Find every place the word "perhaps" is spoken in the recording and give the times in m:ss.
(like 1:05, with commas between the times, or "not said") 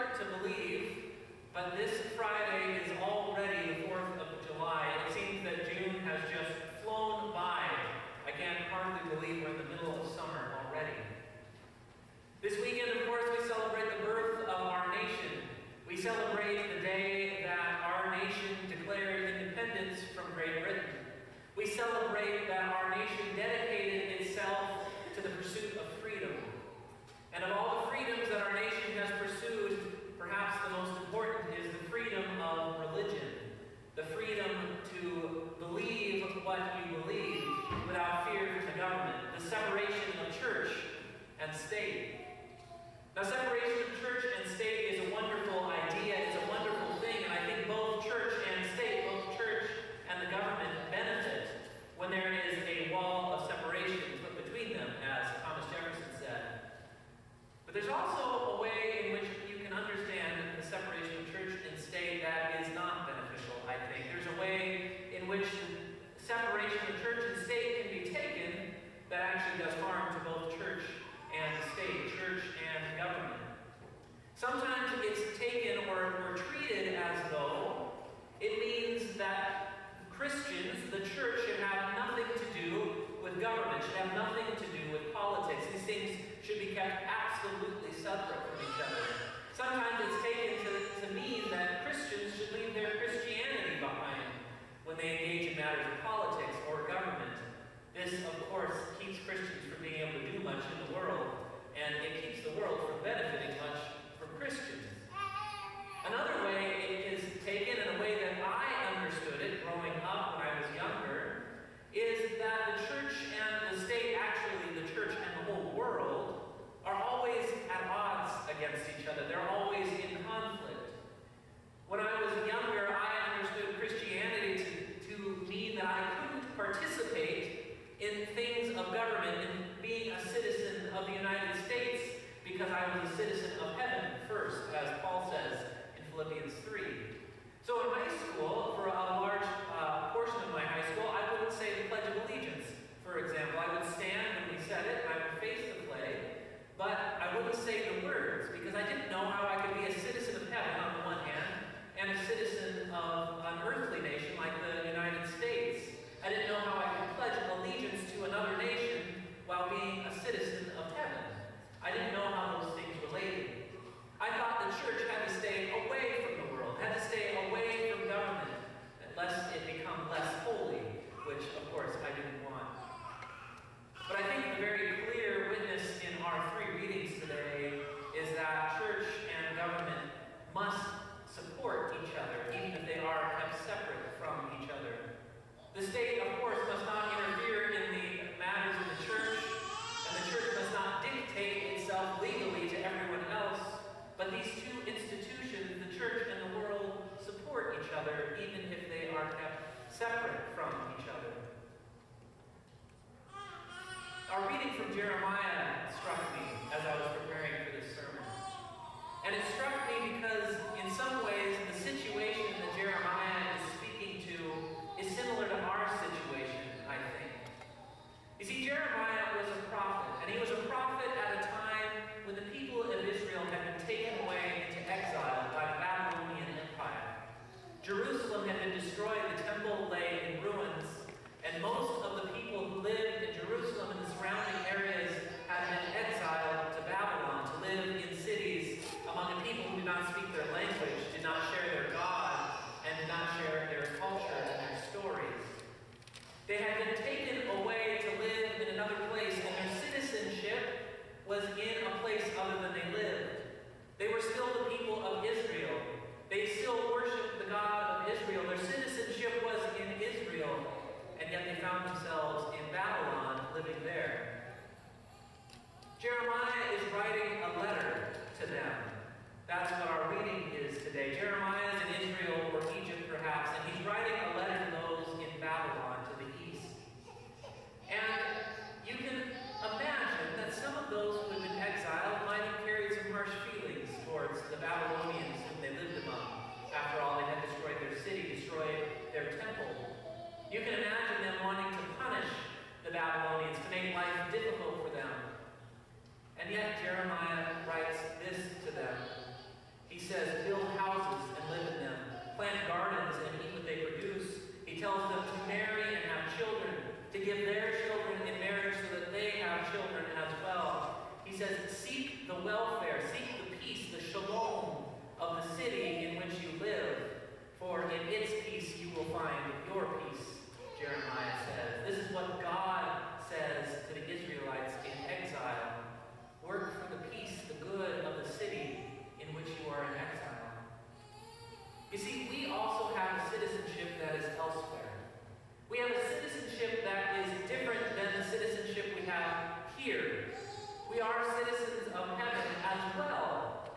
0:30, 4:33.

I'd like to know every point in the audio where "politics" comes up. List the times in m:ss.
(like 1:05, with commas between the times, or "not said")
1:25, 1:36.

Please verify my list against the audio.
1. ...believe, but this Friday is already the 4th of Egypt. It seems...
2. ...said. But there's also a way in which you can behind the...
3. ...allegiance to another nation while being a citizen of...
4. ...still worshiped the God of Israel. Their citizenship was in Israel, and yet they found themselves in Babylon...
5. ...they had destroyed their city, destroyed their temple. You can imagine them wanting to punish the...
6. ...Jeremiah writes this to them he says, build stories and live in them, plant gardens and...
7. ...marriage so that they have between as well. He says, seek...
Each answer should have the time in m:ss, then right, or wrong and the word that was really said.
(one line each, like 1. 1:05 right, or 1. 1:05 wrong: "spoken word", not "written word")
1. 0:00 wrong: "July", not "Egypt"
2. 0:56 wrong: "understand", not "behind"
3. 2:37 right
4. 4:16 right
5. 4:47 right
6. 4:56 wrong: "houses", not "stories"
7. 5:08 wrong: "children", not "between".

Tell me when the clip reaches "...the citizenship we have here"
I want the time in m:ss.
5:38.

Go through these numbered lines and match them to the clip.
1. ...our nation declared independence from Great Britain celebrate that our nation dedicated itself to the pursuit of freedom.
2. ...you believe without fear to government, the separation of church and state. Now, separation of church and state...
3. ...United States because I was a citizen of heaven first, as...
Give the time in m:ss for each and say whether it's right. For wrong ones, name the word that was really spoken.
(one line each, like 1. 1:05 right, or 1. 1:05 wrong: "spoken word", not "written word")
1. 0:17 right
2. 0:36 right
3. 2:11 right.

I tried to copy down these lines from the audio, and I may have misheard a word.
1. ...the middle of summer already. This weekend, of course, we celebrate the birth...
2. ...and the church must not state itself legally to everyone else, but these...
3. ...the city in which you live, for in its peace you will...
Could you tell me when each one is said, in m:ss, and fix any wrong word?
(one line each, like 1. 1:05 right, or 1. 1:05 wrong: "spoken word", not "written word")
1. 0:09 right
2. 3:09 wrong: "dictate", not "state"
3. 5:15 right.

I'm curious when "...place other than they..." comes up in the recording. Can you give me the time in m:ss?
4:12.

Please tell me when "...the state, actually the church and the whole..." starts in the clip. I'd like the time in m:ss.
1:53.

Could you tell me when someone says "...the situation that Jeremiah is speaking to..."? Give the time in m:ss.
3:31.